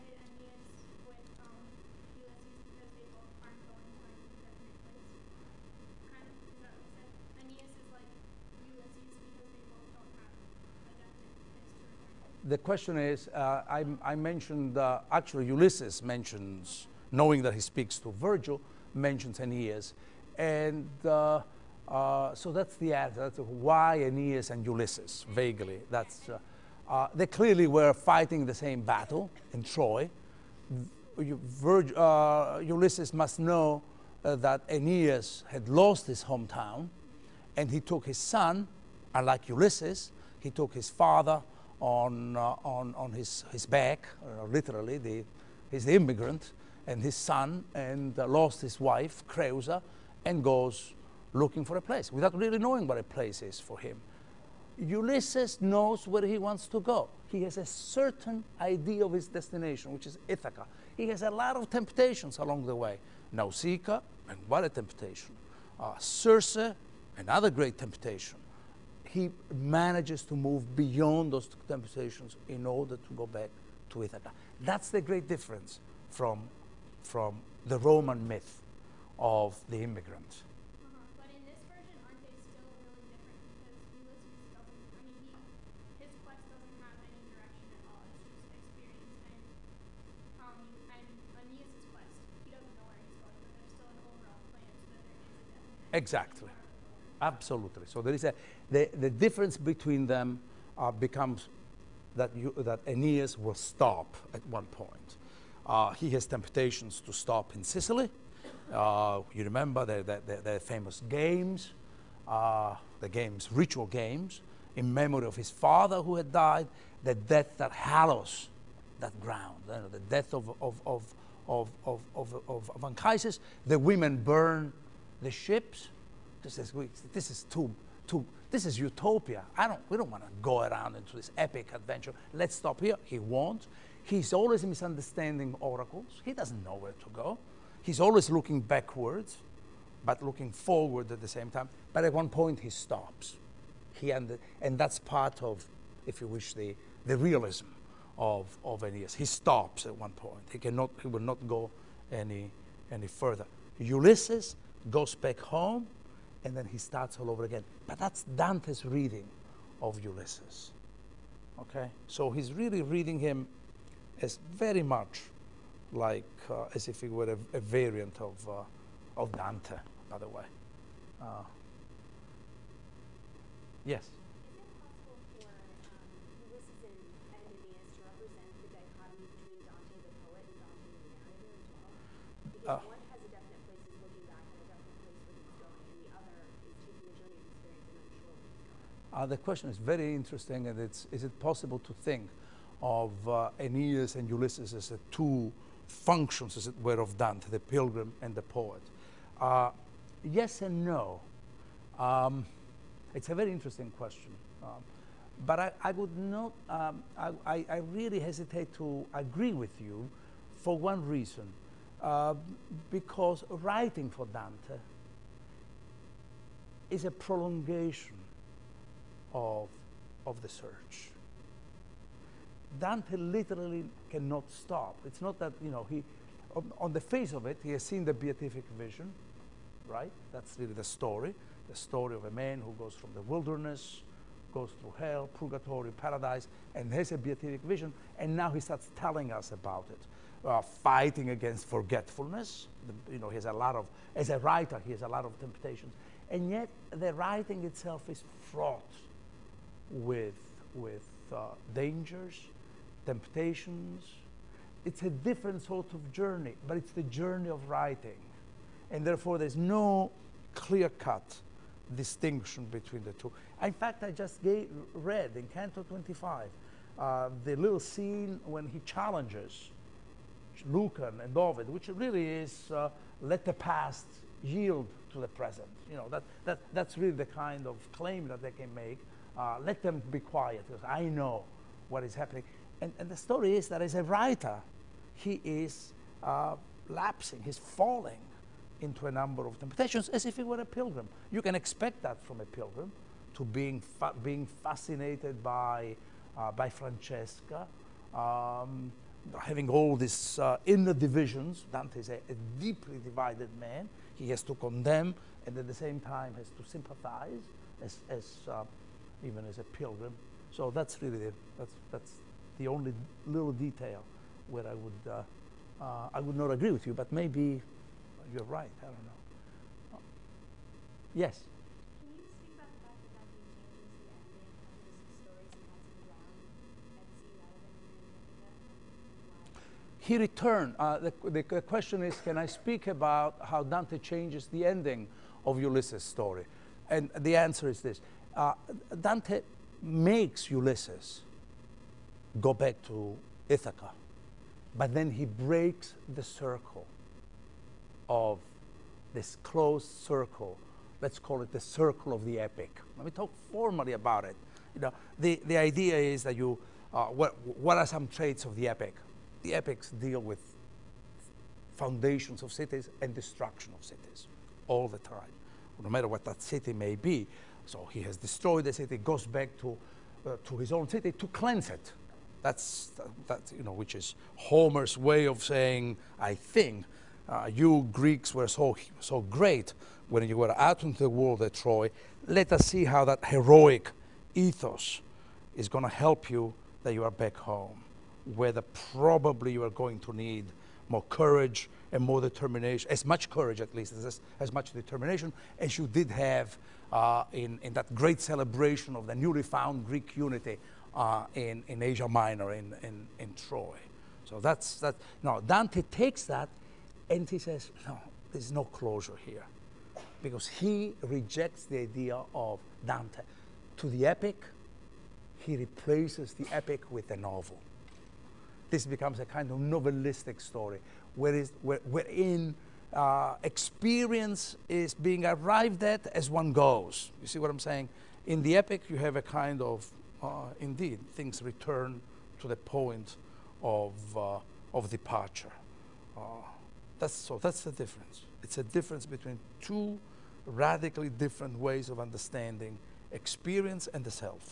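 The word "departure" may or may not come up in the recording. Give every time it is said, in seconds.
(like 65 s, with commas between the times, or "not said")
434 s.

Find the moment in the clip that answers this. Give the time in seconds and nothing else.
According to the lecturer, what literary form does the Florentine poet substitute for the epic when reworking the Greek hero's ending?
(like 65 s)
417 s.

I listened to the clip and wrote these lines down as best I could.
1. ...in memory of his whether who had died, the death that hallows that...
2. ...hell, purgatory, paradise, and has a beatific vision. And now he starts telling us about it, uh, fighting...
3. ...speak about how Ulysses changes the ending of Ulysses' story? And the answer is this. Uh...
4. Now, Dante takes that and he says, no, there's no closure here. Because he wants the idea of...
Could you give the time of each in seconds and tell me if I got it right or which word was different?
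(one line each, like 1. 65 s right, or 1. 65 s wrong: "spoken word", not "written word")
1. 114 s wrong: "father", not "whether"
2. 234 s right
3. 332 s wrong: "Dante", not "Ulysses"
4. 405 s wrong: "rejects", not "wants".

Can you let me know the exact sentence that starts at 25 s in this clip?
That's, uh, uh, they clearly were fighting the same battle in Troy.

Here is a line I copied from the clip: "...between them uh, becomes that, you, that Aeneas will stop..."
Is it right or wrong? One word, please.
right.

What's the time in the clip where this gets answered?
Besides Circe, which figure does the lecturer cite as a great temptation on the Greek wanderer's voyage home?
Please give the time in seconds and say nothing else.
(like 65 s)
63 s.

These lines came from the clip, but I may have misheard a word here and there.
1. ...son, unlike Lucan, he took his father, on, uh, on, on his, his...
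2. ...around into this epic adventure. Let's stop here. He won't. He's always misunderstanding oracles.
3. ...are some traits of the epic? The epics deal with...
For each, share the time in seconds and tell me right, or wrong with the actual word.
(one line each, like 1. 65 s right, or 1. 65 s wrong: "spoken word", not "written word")
1. 38 s wrong: "Ulysses", not "Lucan"
2. 130 s right
3. 357 s right.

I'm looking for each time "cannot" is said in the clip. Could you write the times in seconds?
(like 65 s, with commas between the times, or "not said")
150 s, 224 s.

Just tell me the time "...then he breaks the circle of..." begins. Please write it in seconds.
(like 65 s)
344 s.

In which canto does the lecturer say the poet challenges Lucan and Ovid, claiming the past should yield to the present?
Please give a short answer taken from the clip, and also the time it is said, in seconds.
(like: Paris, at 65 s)
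Canto 25, at 265 s.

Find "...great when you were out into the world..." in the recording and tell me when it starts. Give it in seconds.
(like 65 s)
379 s.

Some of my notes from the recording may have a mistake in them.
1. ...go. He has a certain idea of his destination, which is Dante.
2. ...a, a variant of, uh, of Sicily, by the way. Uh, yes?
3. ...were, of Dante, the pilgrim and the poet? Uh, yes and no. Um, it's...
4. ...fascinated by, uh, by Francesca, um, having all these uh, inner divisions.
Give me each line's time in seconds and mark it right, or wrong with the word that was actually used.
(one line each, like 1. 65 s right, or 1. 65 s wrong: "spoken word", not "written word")
1. 56 s wrong: "Ithaca", not "Dante"
2. 167 s wrong: "Dante", not "Sicily"
3. 196 s right
4. 294 s right.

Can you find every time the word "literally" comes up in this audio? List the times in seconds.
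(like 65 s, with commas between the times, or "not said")
44 s, 223 s.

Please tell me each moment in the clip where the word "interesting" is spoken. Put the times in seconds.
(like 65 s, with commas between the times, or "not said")
190 s, 203 s.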